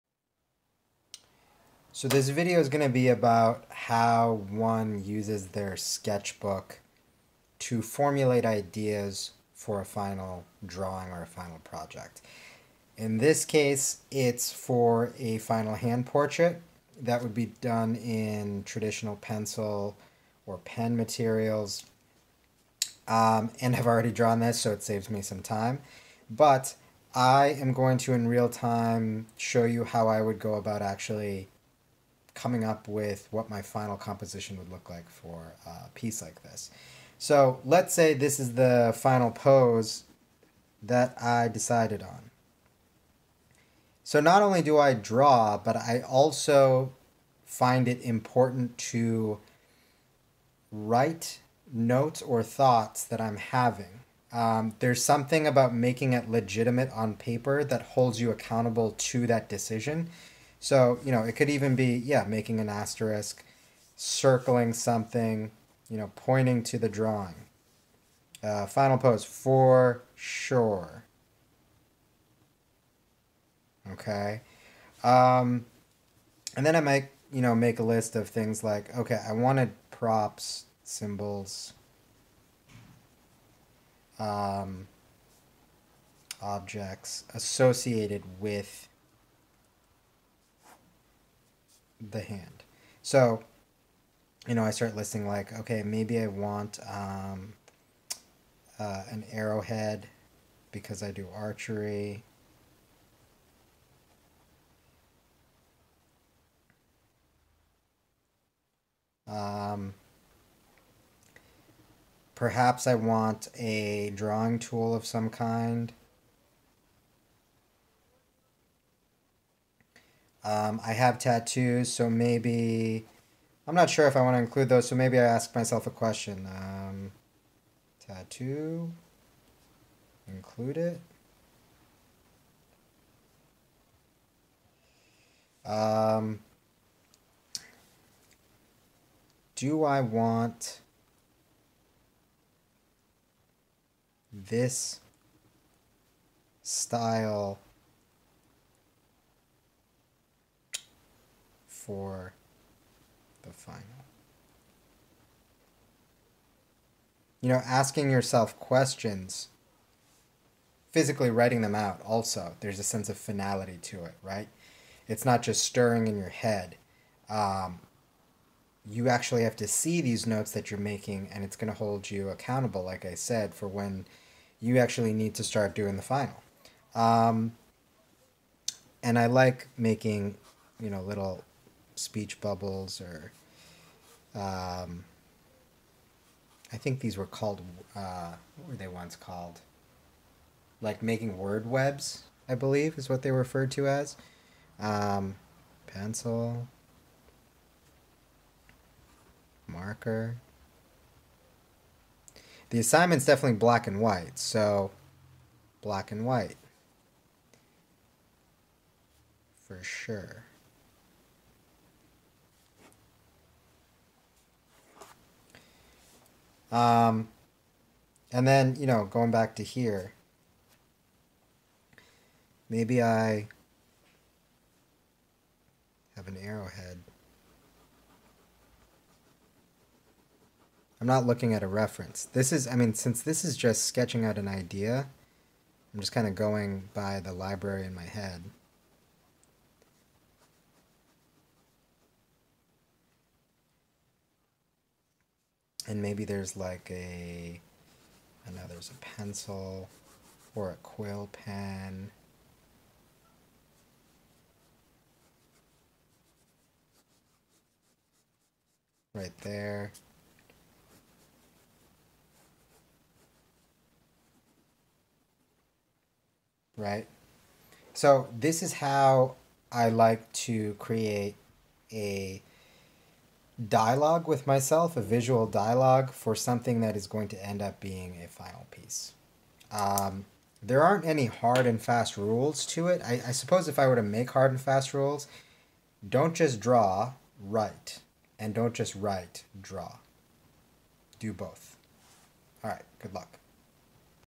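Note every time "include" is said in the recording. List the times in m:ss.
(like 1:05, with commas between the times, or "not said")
2:04, 2:10.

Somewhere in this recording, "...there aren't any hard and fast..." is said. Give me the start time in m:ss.
4:40.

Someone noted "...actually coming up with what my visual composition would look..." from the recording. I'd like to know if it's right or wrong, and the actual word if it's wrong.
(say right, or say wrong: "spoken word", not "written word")
wrong: "final", not "visual".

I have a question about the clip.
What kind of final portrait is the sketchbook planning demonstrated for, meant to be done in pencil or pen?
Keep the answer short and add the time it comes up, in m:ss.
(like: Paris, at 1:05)
Hand portrait, at 0:15.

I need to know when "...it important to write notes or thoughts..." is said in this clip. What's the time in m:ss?
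0:47.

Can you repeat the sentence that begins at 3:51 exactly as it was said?
I'm not looking at a reference.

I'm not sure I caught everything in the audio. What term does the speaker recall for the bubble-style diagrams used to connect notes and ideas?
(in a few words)
Word webs.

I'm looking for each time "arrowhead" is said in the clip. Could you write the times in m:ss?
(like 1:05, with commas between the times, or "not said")
1:39, 3:46.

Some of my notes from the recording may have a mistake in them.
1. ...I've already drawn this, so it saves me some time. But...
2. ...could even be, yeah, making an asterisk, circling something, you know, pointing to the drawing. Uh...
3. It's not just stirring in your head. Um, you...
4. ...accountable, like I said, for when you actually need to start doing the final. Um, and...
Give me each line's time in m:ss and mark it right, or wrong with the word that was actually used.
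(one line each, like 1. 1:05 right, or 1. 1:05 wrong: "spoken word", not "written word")
1. 0:23 right
2. 1:01 right
3. 2:45 right
4. 2:52 right.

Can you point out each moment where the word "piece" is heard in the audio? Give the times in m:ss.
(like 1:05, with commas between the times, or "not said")
0:35, 4:38.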